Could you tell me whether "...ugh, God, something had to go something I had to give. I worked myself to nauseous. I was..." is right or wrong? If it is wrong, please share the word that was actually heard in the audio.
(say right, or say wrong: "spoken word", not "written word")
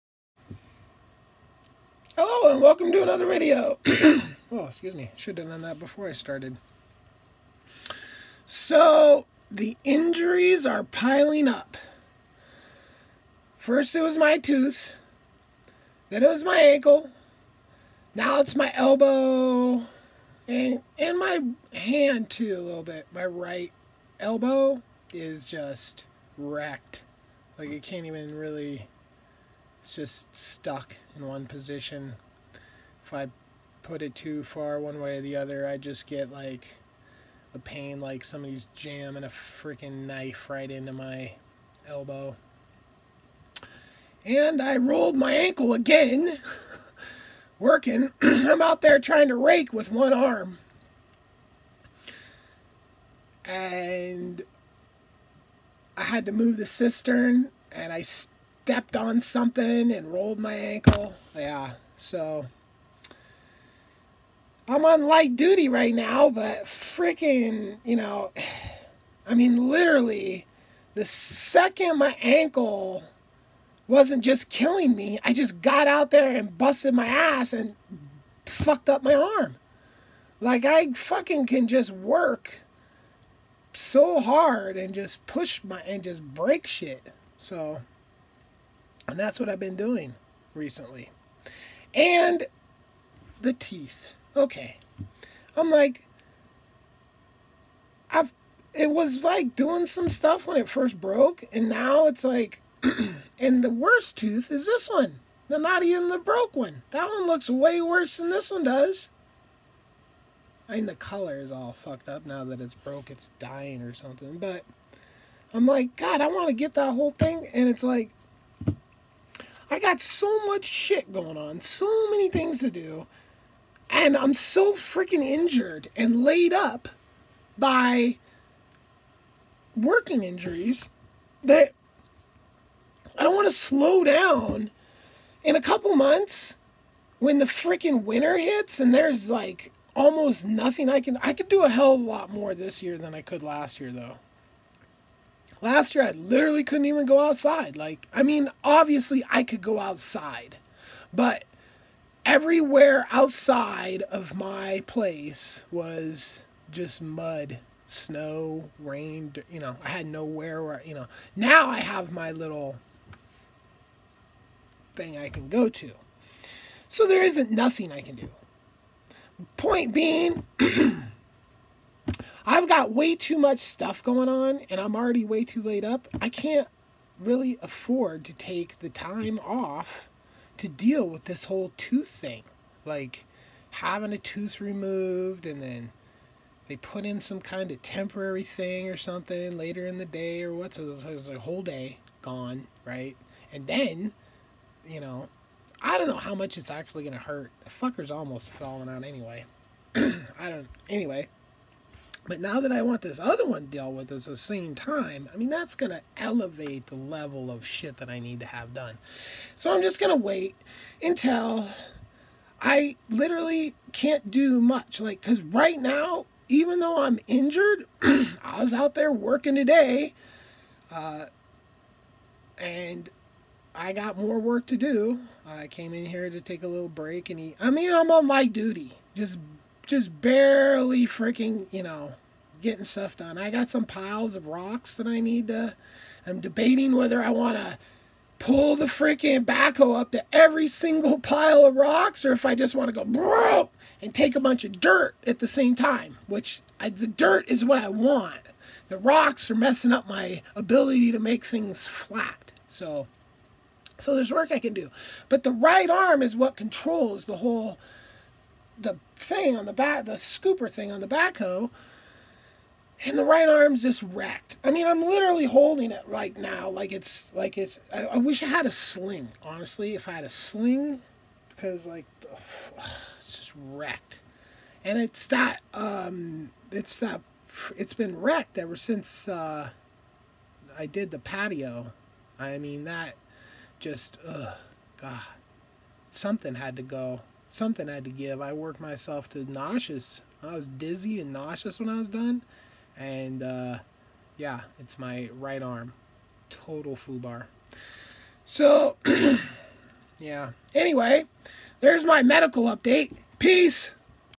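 right.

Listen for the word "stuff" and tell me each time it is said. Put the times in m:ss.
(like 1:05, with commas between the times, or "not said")
1:40, 2:53, 3:52.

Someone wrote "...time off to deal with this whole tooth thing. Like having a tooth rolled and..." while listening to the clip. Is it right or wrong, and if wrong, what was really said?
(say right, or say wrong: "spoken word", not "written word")
wrong: "removed", not "rolled".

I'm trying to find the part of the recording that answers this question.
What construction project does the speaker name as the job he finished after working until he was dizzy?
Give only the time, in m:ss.
4:41.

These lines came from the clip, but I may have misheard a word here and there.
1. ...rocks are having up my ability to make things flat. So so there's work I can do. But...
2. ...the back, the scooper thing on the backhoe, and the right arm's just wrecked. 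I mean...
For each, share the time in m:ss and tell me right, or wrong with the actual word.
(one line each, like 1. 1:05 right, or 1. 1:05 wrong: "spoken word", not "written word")
1. 4:08 wrong: "messing", not "having"
2. 4:19 right.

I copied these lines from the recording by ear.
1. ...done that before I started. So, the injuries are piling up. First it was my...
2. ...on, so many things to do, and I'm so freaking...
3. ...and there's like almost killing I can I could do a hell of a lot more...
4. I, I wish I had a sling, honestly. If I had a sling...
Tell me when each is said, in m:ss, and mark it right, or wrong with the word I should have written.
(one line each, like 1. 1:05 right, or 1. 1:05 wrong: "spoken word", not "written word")
1. 0:05 right
2. 2:01 right
3. 2:18 wrong: "nothing", not "killing"
4. 4:27 right.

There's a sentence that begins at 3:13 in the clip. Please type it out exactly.
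And then, you know, I don't know how much it's actually gonna hurt.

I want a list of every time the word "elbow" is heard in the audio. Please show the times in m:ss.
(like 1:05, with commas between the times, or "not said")
0:18, 0:24, 0:41.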